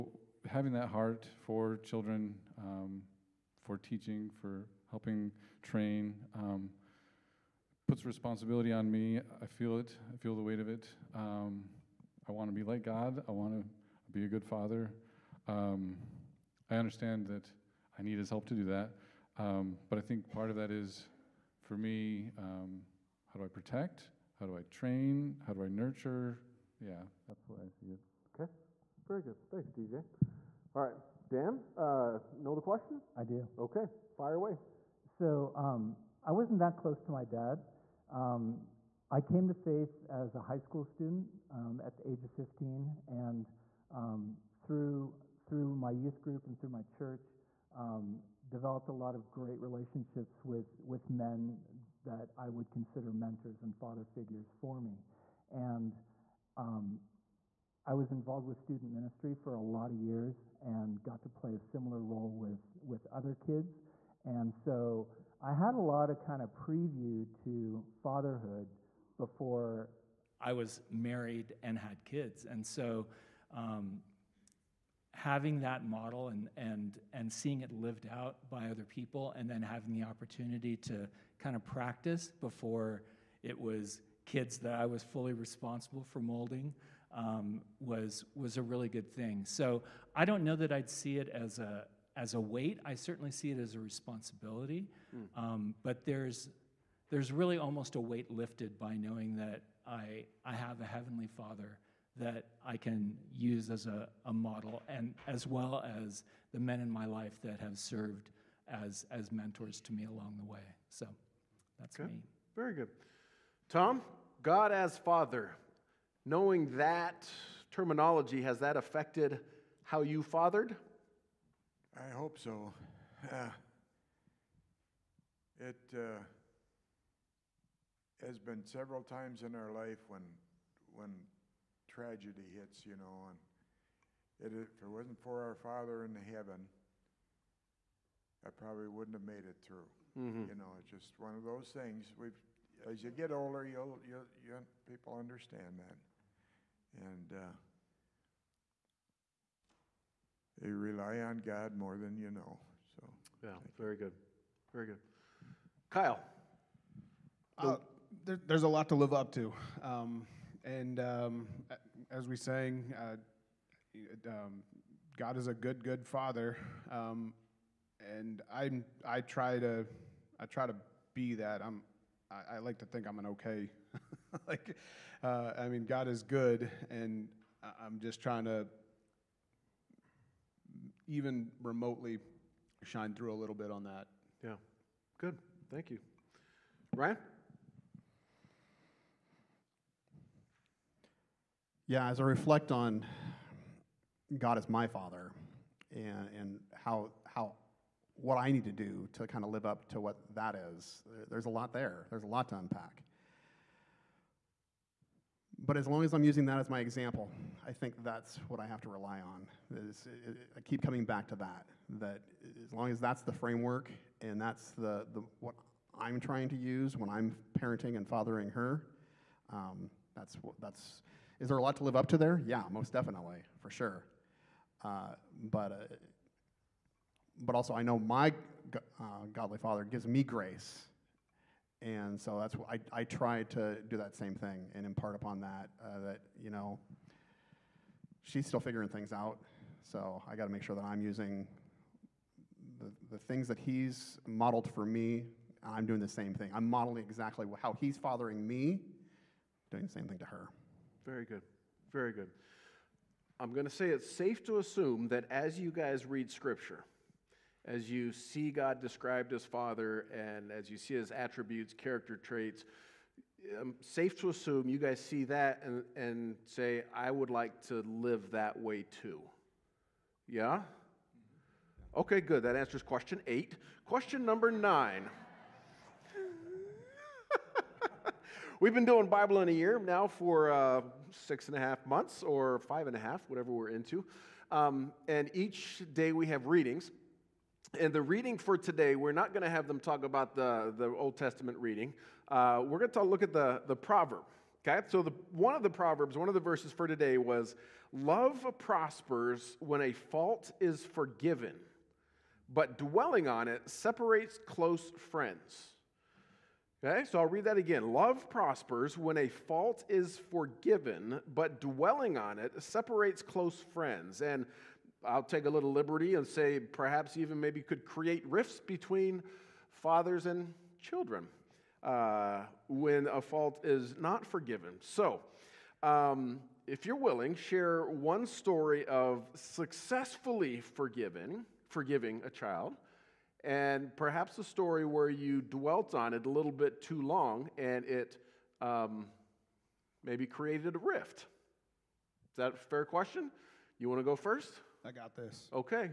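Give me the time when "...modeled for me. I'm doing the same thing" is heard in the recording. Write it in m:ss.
4:04.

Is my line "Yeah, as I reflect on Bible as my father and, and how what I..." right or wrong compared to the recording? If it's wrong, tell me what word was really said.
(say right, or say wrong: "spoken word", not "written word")
wrong: "God", not "Bible".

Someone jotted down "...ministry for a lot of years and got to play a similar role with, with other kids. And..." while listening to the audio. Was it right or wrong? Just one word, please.
right.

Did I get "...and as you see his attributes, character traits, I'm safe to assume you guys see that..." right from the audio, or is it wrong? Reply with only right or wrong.
right.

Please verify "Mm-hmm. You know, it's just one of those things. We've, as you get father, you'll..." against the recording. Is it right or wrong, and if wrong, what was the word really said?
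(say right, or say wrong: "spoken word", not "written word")
wrong: "older", not "father".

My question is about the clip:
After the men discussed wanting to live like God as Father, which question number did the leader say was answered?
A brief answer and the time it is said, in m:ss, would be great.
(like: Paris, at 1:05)
8, at 4:33.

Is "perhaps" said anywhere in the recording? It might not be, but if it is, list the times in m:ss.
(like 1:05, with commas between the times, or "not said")
5:16, 5:33.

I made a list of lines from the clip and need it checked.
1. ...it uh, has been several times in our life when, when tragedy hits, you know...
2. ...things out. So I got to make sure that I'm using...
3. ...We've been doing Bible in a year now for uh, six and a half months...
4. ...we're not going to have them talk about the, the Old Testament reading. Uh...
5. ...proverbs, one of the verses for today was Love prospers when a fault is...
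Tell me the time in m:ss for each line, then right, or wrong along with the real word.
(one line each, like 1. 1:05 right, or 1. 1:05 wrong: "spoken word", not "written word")
1. 2:05 right
2. 3:58 right
3. 4:38 right
4. 4:48 right
5. 4:55 right.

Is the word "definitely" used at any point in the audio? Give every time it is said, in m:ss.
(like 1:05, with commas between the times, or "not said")
3:42.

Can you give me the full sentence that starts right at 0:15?
Um, I understand that I need His help to do that.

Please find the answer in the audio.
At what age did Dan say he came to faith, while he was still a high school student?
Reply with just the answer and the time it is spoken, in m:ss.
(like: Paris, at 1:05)
15, at 0:42.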